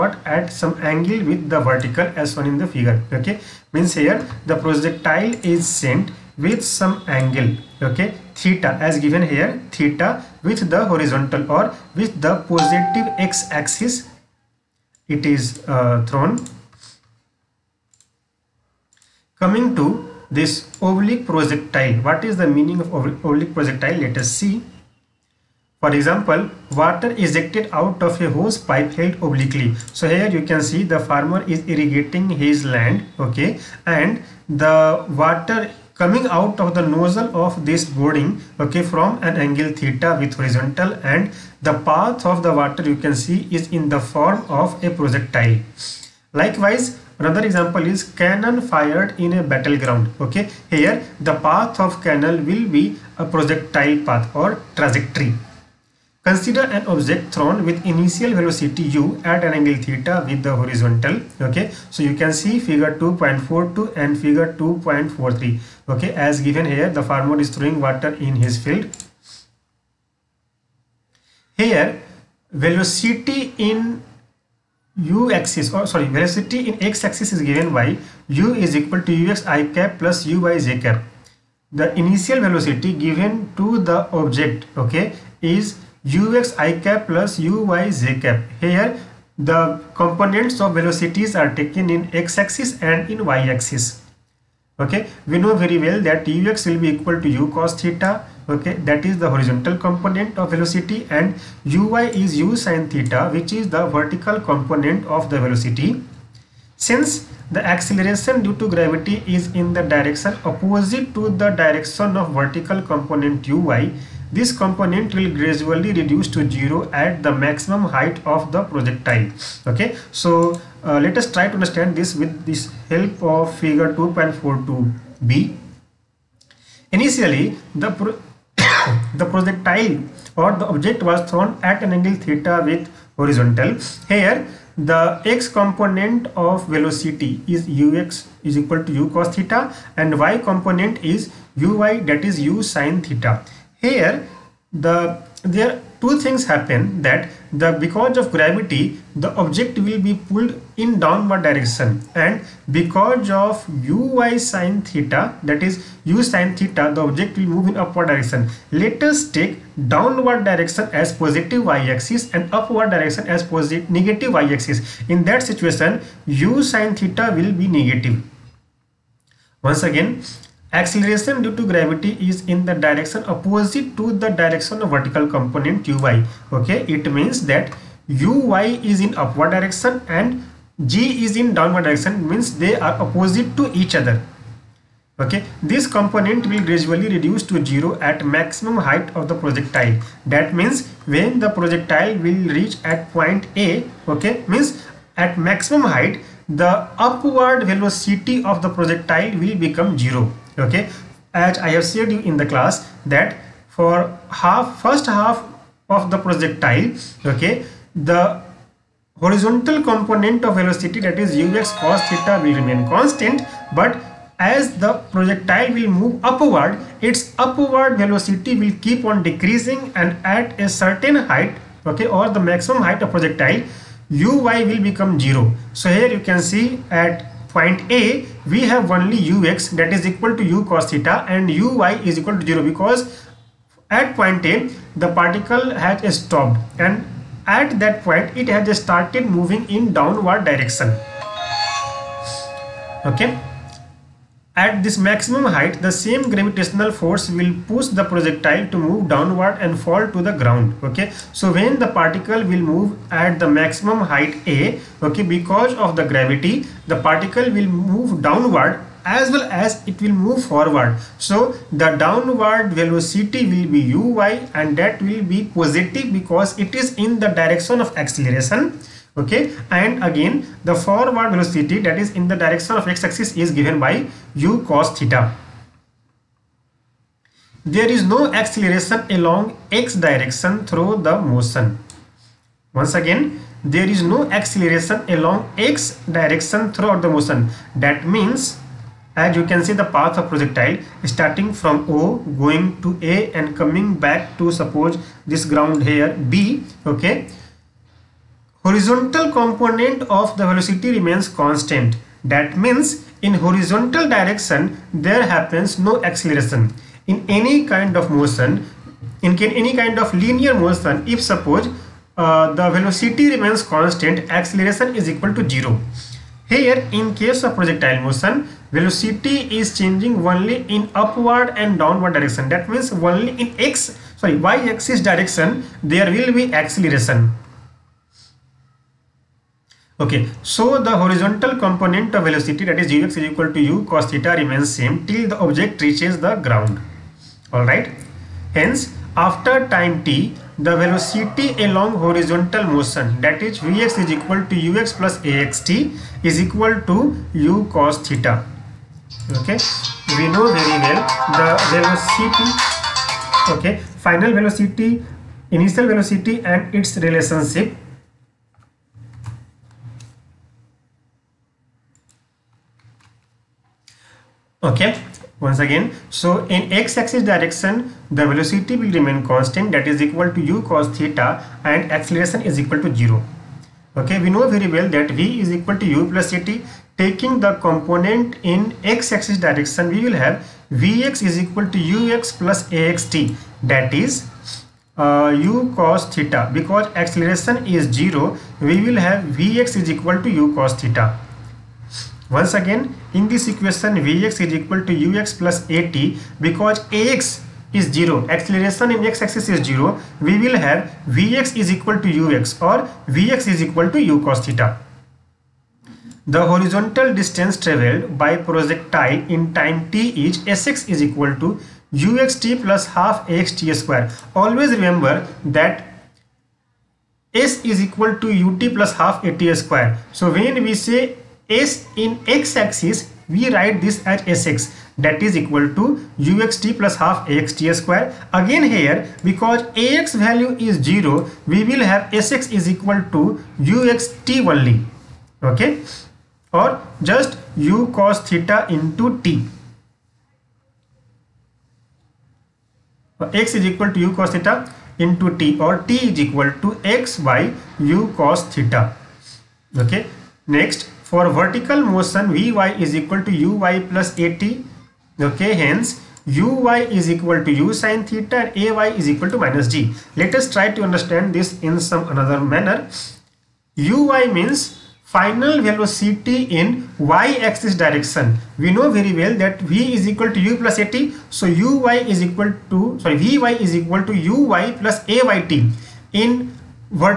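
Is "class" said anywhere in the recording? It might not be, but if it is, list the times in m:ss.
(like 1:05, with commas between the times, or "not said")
3:22.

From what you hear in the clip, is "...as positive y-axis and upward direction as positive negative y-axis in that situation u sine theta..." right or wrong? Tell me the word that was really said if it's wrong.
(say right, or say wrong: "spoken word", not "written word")
right.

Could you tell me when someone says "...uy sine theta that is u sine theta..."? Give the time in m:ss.
2:33.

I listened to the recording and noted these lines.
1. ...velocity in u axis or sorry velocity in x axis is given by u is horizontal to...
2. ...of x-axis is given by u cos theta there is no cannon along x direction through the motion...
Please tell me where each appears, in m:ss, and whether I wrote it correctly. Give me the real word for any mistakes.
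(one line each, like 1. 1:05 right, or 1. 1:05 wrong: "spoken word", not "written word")
1. 1:12 wrong: "equal", not "horizontal"
2. 4:32 wrong: "acceleration", not "cannon".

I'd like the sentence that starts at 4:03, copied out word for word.
Okay at this maximum height, the same gravitational force will push the projectile to move downward and fall to the ground.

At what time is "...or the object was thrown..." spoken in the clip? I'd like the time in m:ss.
2:10.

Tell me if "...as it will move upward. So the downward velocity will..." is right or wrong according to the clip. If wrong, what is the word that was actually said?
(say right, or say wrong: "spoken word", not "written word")
wrong: "forward", not "upward".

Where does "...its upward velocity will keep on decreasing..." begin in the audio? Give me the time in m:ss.
3:37.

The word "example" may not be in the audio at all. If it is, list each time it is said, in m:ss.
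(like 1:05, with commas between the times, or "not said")
0:25, 0:47.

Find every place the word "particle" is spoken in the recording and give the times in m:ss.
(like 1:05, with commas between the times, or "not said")
3:55, 4:11, 4:16.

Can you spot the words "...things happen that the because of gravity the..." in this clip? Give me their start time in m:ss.
2:26.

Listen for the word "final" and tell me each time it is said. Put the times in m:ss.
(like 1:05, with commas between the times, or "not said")
5:54, 7:45.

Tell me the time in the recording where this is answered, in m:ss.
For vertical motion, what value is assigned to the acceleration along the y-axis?
7:38.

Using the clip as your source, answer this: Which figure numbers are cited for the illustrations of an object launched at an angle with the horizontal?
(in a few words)
2.42 and 2.43.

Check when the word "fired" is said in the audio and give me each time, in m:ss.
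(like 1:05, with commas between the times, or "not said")
0:48.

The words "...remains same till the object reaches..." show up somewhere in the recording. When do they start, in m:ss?
5:34.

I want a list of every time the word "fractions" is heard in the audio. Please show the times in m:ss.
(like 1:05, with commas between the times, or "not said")
not said.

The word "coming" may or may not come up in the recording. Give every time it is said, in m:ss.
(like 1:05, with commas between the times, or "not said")
0:19, 0:35, 4:53.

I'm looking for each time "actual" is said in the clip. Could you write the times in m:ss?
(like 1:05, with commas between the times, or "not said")
not said.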